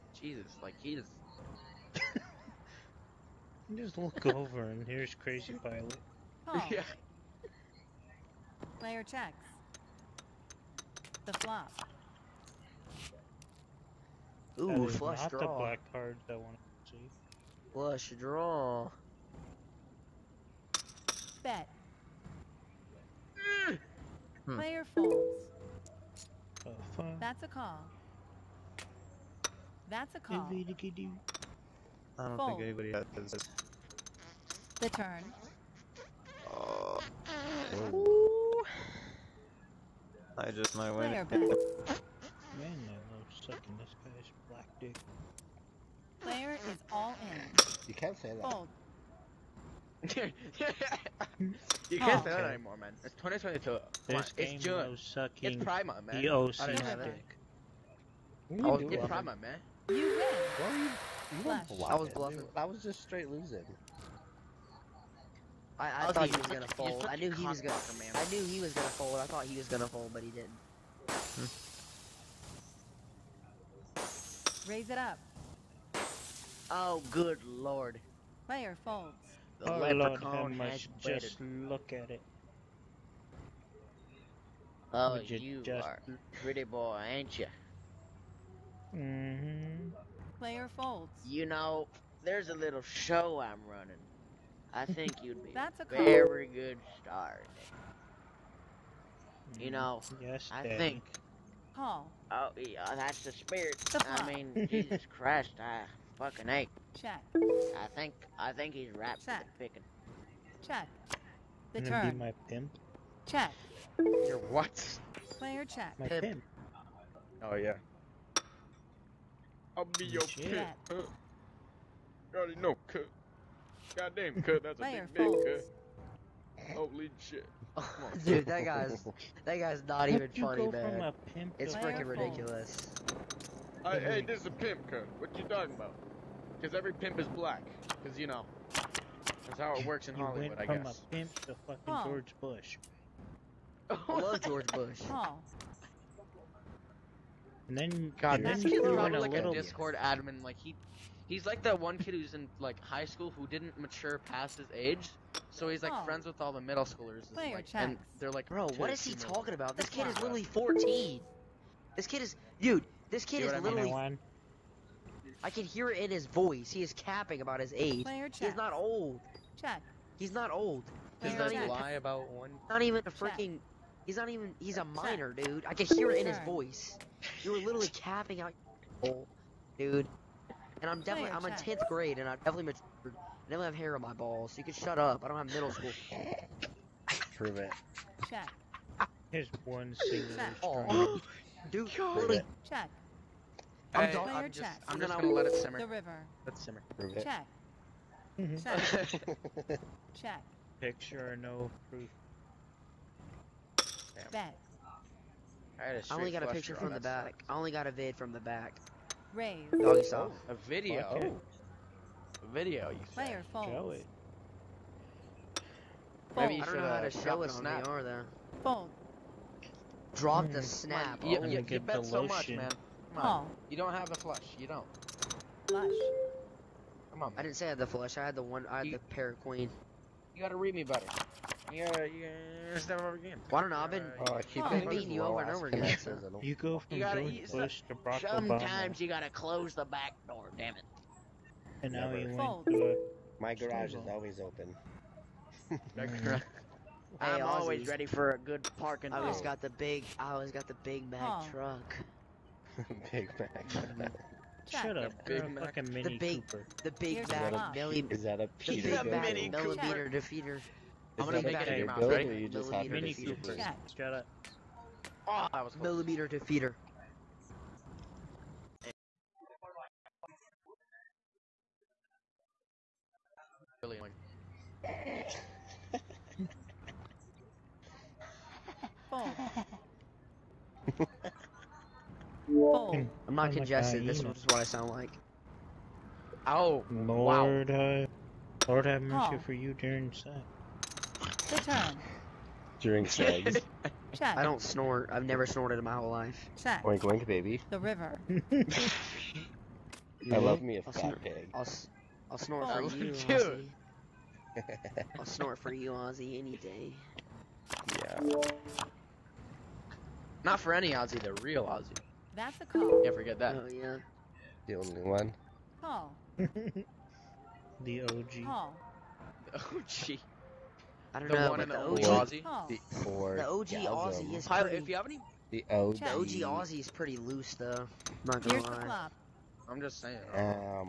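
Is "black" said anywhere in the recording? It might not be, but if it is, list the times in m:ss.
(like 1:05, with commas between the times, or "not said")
0:15, 0:44, 2:17.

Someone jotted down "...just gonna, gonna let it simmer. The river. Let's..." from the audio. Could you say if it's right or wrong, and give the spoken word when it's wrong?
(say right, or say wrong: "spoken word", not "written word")
right.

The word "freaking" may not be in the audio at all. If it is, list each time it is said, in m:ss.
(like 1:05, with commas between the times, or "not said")
2:11, 2:53.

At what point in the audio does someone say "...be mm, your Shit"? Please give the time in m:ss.
1:59.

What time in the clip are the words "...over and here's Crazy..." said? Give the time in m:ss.
0:04.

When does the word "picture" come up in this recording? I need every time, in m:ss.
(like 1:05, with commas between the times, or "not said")
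3:20, 3:26.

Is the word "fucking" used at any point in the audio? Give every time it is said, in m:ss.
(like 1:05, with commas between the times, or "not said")
1:46, 2:21, 4:15.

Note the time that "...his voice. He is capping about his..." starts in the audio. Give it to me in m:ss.
2:46.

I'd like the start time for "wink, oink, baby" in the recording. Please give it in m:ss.
4:56.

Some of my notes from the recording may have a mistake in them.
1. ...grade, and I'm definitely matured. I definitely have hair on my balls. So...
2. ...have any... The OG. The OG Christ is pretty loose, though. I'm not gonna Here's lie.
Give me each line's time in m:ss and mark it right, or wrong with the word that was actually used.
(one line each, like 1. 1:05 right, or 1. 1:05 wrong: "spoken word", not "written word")
1. 3:01 right
2. 5:24 wrong: "Aussie", not "Christ".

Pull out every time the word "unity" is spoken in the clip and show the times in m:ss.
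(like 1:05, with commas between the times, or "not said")
not said.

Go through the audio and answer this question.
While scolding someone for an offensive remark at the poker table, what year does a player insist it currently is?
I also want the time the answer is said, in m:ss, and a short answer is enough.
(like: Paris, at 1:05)
2022, at 0:53.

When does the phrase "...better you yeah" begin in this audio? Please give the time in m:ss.
3:50.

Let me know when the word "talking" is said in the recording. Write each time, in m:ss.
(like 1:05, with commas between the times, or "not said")
2:15, 2:39.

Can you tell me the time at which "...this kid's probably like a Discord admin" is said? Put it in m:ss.
2:28.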